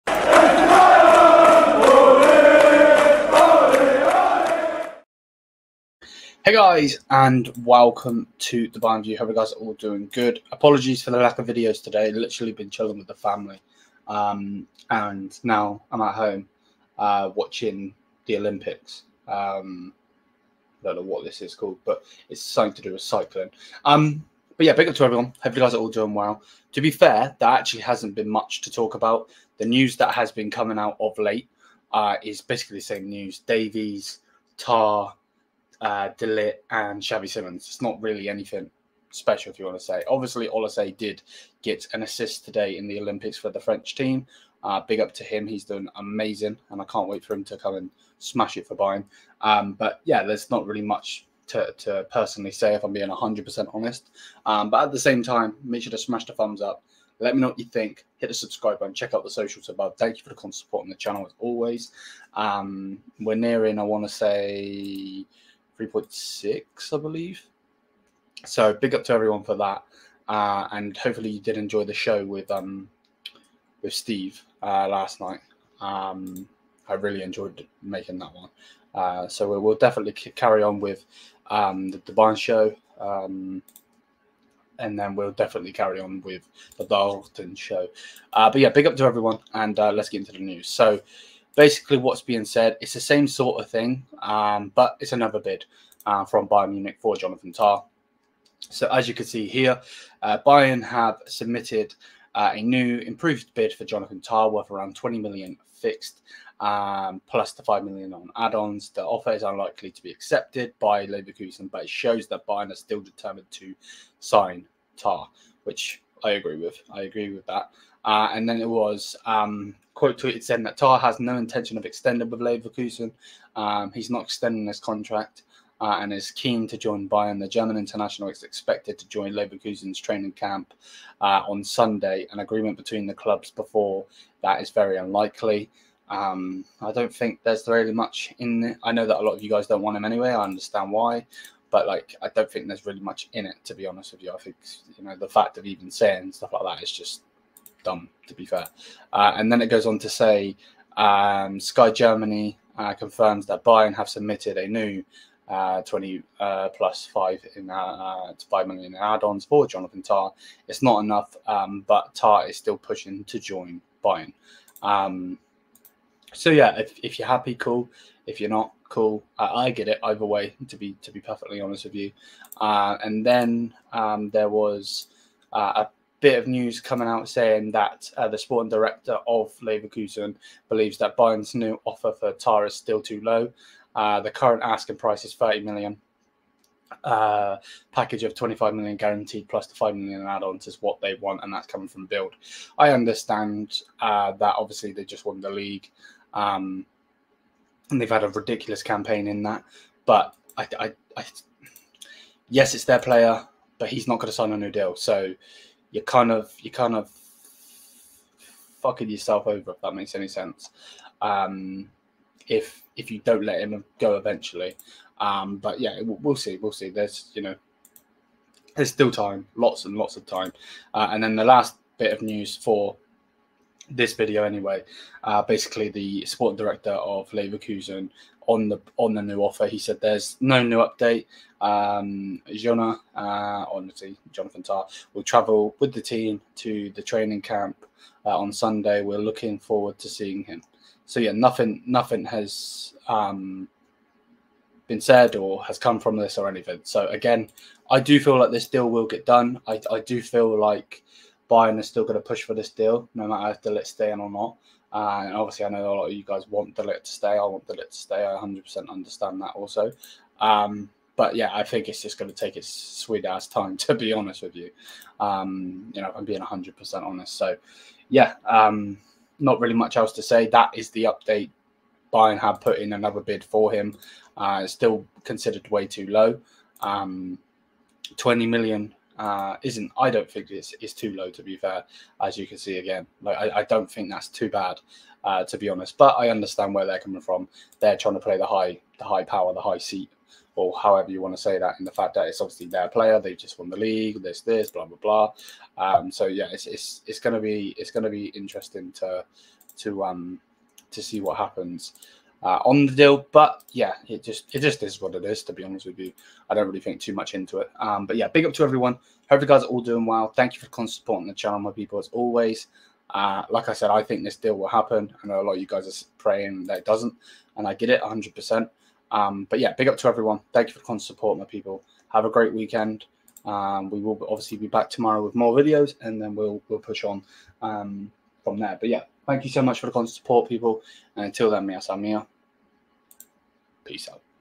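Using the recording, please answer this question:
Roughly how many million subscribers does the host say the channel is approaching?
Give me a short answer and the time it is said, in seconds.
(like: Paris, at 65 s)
3.6, at 65 s.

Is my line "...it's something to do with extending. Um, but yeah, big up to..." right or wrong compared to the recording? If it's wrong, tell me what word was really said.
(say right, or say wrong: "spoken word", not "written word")
wrong: "cycling", not "extending".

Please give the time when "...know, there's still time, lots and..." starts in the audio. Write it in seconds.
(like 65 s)
217 s.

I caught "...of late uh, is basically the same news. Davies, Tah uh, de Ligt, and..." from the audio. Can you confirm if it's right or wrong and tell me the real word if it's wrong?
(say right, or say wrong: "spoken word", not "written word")
right.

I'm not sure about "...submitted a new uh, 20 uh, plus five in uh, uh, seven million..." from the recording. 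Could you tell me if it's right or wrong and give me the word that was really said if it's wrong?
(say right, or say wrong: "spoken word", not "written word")
wrong: "five", not "seven".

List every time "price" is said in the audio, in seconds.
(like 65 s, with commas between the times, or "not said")
184 s.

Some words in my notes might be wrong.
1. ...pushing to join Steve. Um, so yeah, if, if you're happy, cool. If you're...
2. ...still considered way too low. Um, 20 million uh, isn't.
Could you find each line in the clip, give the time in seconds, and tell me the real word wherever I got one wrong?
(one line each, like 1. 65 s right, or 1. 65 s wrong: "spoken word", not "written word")
1. 162 s wrong: "Bayern", not "Steve"
2. 274 s right.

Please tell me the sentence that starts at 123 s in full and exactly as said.
Um, he's not extending his contract uh, and is keen to join Bayern.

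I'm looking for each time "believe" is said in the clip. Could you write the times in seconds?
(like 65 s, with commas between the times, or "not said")
67 s, 180 s.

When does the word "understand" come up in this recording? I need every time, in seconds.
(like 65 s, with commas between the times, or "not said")
140 s, 192 s, 258 s, 286 s.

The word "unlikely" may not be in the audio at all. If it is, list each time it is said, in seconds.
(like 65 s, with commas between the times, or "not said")
109 s, 134 s.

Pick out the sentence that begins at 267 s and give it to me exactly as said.
So yeah, um, not really much else to say.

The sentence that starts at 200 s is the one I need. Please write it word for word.
But I, I, I yes, it's their player, but he's not going to sign a new deal.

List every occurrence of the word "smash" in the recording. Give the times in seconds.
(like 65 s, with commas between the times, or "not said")
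48 s, 55 s.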